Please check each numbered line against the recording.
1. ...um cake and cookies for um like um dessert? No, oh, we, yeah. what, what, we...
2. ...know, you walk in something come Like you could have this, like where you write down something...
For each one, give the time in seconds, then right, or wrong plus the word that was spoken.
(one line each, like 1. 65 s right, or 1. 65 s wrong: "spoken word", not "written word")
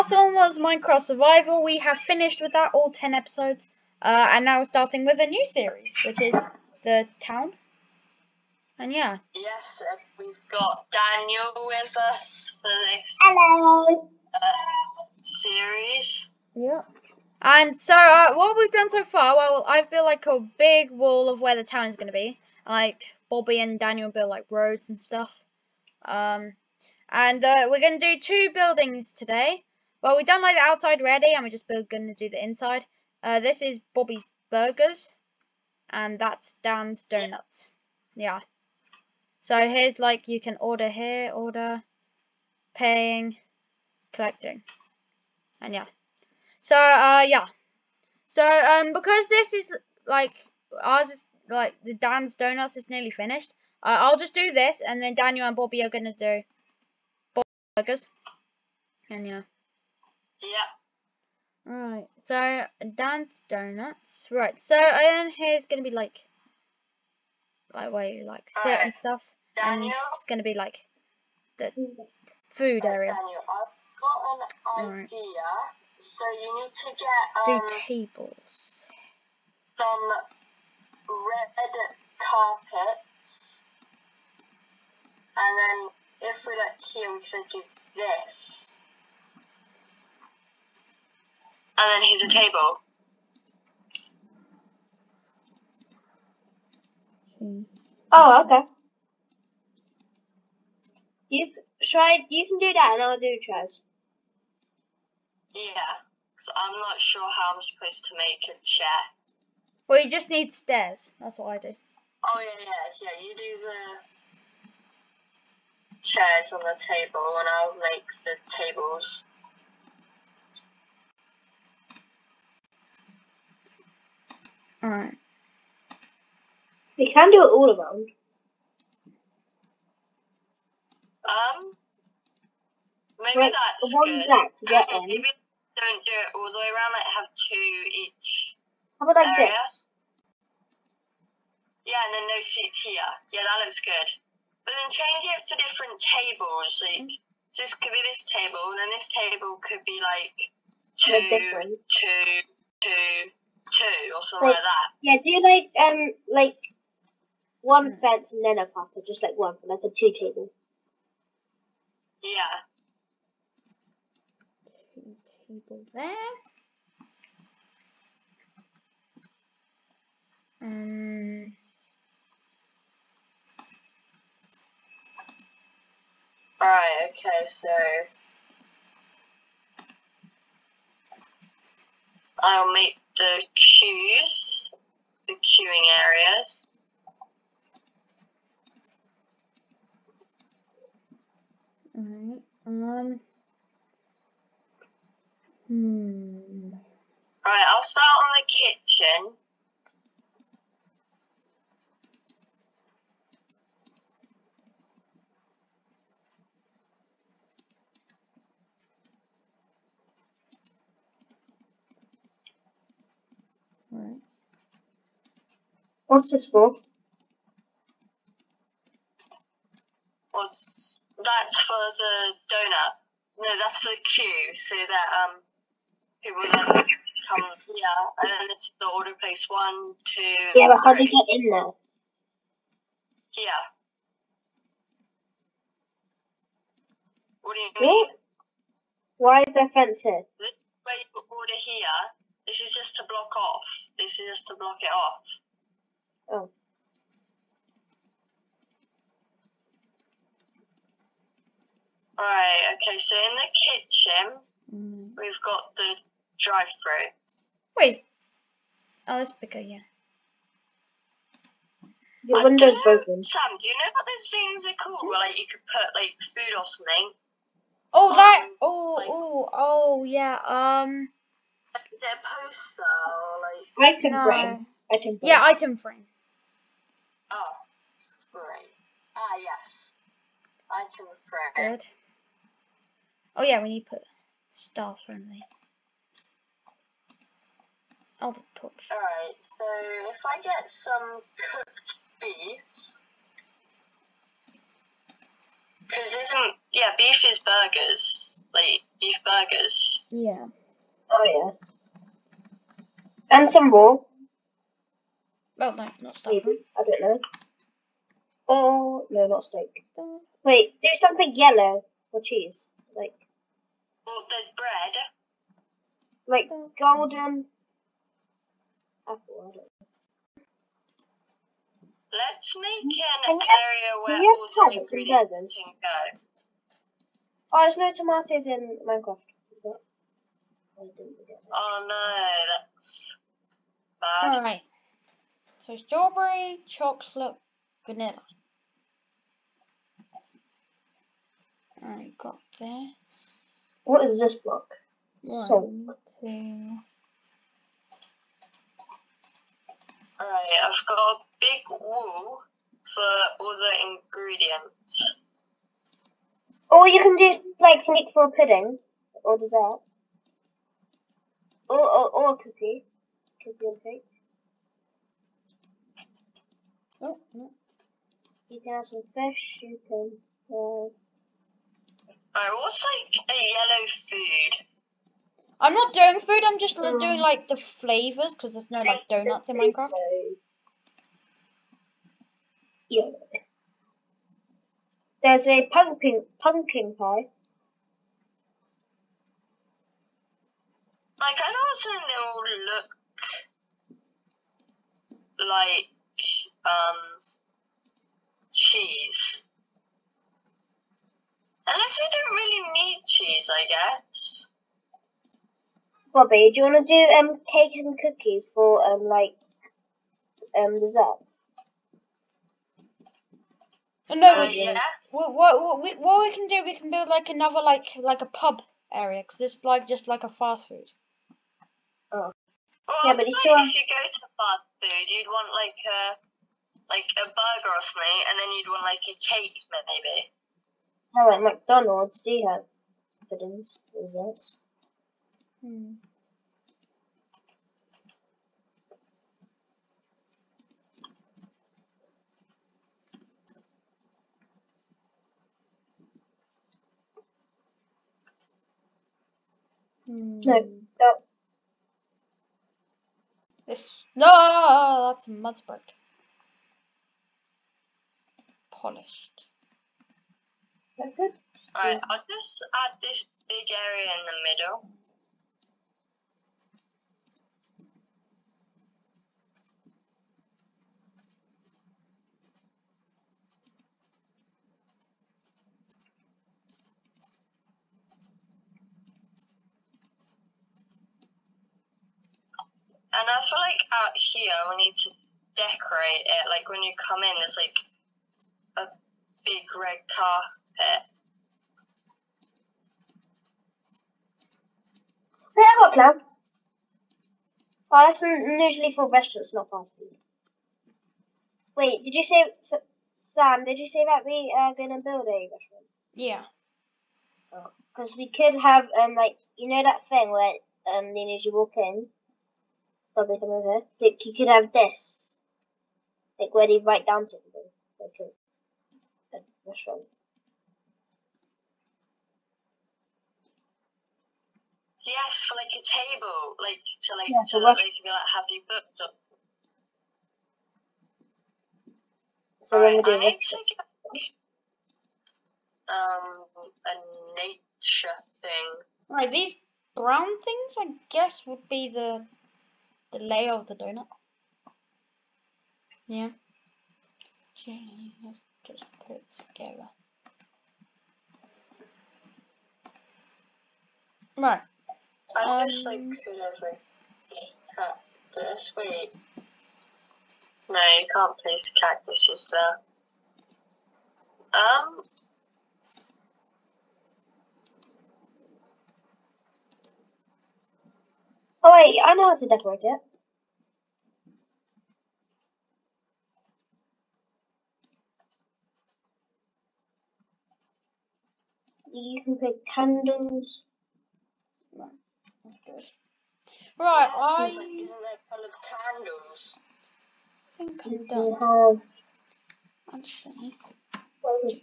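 1. 407 s right
2. 511 s right.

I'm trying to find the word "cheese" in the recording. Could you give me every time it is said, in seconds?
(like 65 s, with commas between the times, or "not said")
312 s, 398 s, 403 s.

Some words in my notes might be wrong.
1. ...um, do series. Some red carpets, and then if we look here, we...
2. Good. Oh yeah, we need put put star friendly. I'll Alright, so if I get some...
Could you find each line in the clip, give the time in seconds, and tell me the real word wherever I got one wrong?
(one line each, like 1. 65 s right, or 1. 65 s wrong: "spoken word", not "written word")
1. 77 s wrong: "tables", not "series"
2. 281 s right.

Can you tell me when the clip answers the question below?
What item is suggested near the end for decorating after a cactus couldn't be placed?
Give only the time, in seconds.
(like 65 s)
582 s.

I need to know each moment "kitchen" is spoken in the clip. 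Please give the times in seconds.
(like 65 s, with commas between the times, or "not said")
198 s, 253 s.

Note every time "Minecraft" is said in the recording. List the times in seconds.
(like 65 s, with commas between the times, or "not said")
0 s, 328 s, 379 s.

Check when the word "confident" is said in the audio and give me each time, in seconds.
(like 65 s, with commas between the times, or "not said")
not said.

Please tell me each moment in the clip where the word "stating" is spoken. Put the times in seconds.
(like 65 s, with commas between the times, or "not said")
not said.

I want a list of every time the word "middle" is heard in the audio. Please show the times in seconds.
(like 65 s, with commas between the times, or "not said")
464 s.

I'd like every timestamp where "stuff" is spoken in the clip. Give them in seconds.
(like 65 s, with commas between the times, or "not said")
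24 s, 68 s, 306 s.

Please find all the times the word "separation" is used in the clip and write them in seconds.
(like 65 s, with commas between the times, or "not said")
not said.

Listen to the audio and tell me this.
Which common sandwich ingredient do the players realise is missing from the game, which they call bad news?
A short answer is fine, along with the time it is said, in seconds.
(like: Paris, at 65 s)
tomatoes, at 327 s.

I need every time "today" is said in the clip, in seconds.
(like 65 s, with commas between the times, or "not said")
29 s.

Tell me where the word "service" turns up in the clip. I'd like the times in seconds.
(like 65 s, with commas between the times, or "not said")
not said.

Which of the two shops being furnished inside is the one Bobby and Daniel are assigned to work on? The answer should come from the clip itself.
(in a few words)
Bobby's Burgers.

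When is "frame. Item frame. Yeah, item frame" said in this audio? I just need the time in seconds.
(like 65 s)
274 s.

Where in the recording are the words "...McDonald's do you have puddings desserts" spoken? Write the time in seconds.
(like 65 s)
431 s.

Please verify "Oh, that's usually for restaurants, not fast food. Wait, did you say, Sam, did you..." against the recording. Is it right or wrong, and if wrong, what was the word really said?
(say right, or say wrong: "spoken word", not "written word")
right.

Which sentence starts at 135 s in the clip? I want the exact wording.
Maybe don't do it all the way around, like have two each.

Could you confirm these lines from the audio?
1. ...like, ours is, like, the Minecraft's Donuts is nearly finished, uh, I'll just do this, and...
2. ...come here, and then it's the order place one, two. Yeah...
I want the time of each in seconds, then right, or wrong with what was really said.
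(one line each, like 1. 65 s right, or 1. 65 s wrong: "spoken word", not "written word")
1. 50 s wrong: "Dan", not "Minecraft"
2. 226 s right.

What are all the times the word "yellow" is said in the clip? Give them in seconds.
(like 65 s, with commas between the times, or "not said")
311 s, 373 s.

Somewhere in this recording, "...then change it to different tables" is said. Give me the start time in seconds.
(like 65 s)
144 s.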